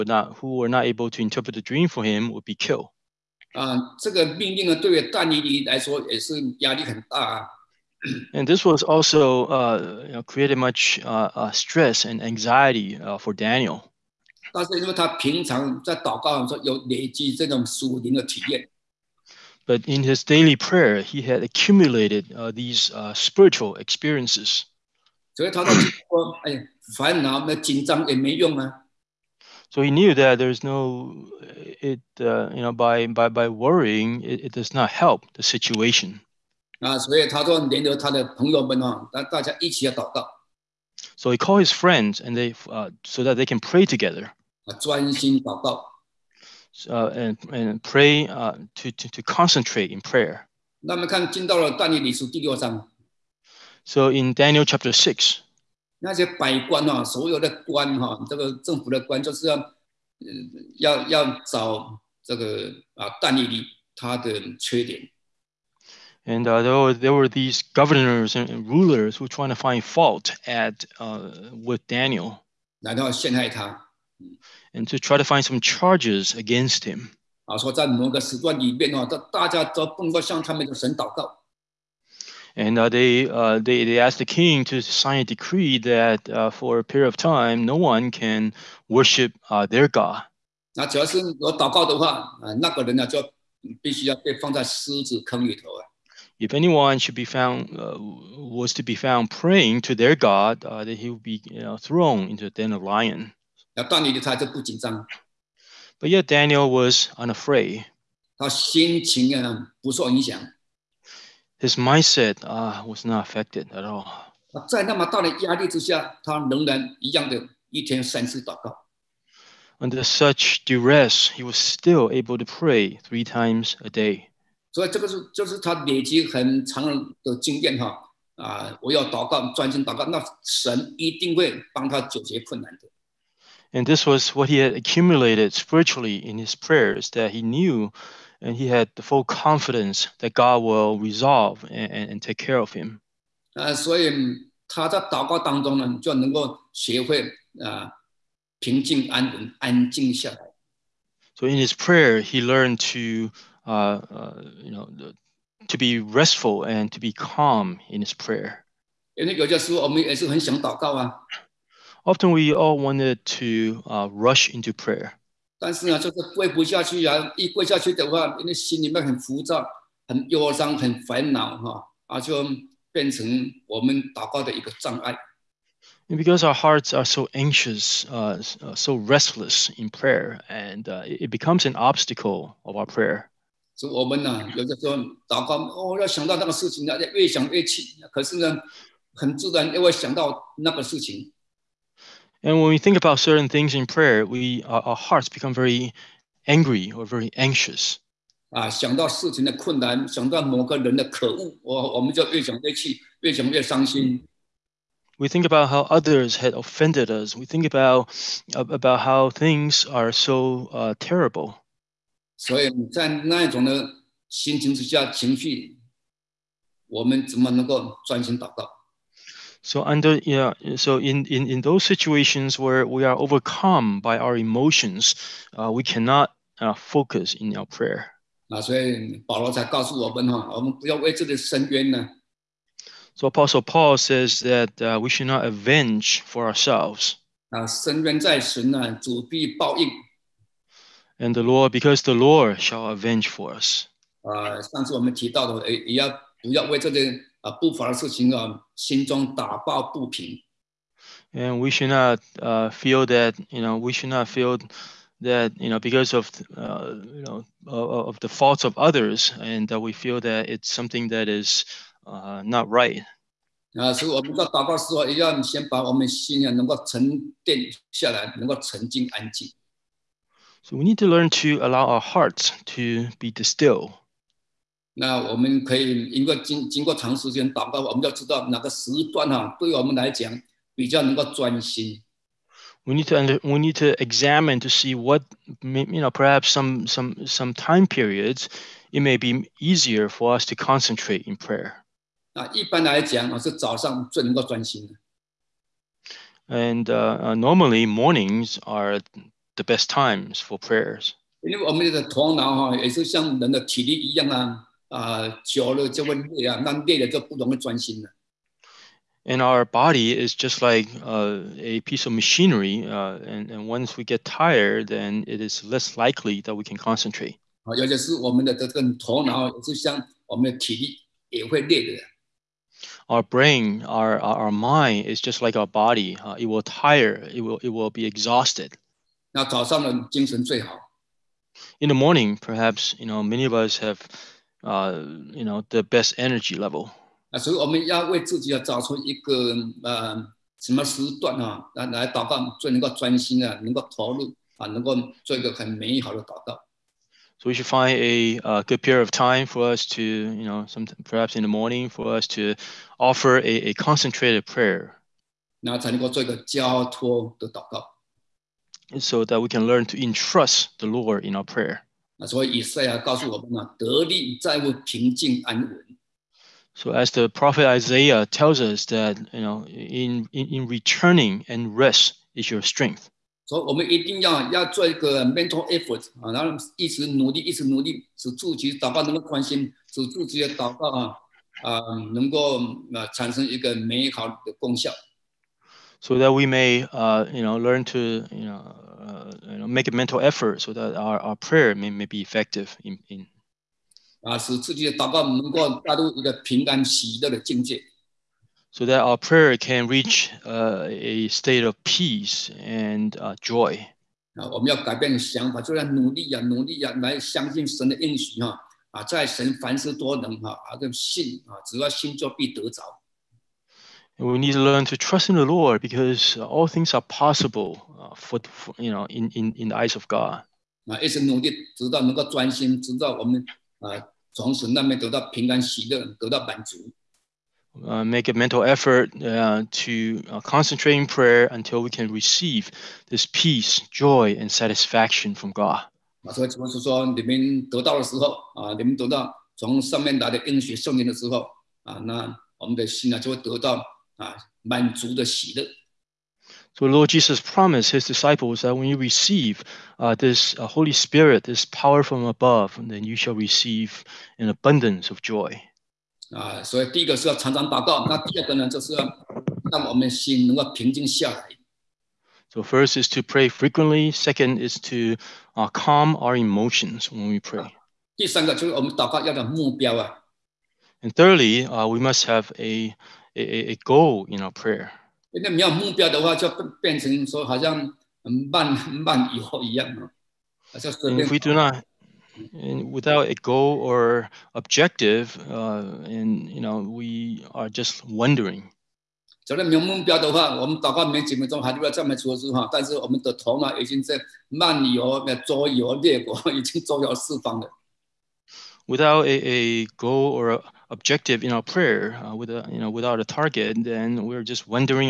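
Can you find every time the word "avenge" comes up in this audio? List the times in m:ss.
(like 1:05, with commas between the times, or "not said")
3:55, 4:02.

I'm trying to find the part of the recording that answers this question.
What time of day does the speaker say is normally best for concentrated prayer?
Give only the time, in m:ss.
4:57.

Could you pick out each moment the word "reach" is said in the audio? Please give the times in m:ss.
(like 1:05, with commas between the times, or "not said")
6:39.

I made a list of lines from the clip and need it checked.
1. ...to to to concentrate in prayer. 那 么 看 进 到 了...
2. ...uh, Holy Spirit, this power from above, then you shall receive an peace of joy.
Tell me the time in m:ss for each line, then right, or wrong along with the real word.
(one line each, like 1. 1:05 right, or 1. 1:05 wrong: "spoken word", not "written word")
1. 0:48 right
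2. 7:30 wrong: "abundance", not "peace".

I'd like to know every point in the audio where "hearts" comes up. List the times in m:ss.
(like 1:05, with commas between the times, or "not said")
2:56, 3:14, 4:32.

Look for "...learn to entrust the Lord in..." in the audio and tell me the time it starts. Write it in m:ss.
5:59.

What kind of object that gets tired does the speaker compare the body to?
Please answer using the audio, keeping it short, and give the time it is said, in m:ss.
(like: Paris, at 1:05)
a piece of machinery, at 5:11.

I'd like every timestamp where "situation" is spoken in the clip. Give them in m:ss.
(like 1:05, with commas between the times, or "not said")
0:35, 3:41.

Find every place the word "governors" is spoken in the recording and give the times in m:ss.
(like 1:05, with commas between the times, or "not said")
1:07.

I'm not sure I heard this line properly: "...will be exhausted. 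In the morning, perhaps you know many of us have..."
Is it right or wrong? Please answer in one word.
right.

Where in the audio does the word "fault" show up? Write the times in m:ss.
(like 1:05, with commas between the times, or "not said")
1:09, 4:18.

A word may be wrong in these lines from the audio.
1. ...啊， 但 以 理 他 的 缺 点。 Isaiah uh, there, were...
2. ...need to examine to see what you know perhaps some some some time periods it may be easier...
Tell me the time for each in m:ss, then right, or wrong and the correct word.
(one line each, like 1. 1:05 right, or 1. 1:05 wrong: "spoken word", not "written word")
1. 1:02 wrong: "And", not "Isaiah"
2. 4:43 right.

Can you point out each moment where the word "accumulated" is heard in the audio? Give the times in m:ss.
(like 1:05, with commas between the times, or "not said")
0:21, 2:14.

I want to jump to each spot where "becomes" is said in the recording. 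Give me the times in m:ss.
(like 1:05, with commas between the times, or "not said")
3:01, 3:15.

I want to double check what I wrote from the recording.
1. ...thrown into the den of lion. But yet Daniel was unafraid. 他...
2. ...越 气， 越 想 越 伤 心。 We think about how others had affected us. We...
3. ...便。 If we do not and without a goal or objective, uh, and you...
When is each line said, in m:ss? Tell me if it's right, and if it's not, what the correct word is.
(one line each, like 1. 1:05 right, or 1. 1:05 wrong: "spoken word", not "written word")
1. 1:41 right
2. 3:22 wrong: "offended", not "affected"
3. 8:01 right.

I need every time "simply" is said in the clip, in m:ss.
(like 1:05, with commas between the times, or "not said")
not said.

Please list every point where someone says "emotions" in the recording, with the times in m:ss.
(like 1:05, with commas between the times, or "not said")
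3:44, 7:46.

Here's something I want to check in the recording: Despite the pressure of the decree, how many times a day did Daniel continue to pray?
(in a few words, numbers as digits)
3.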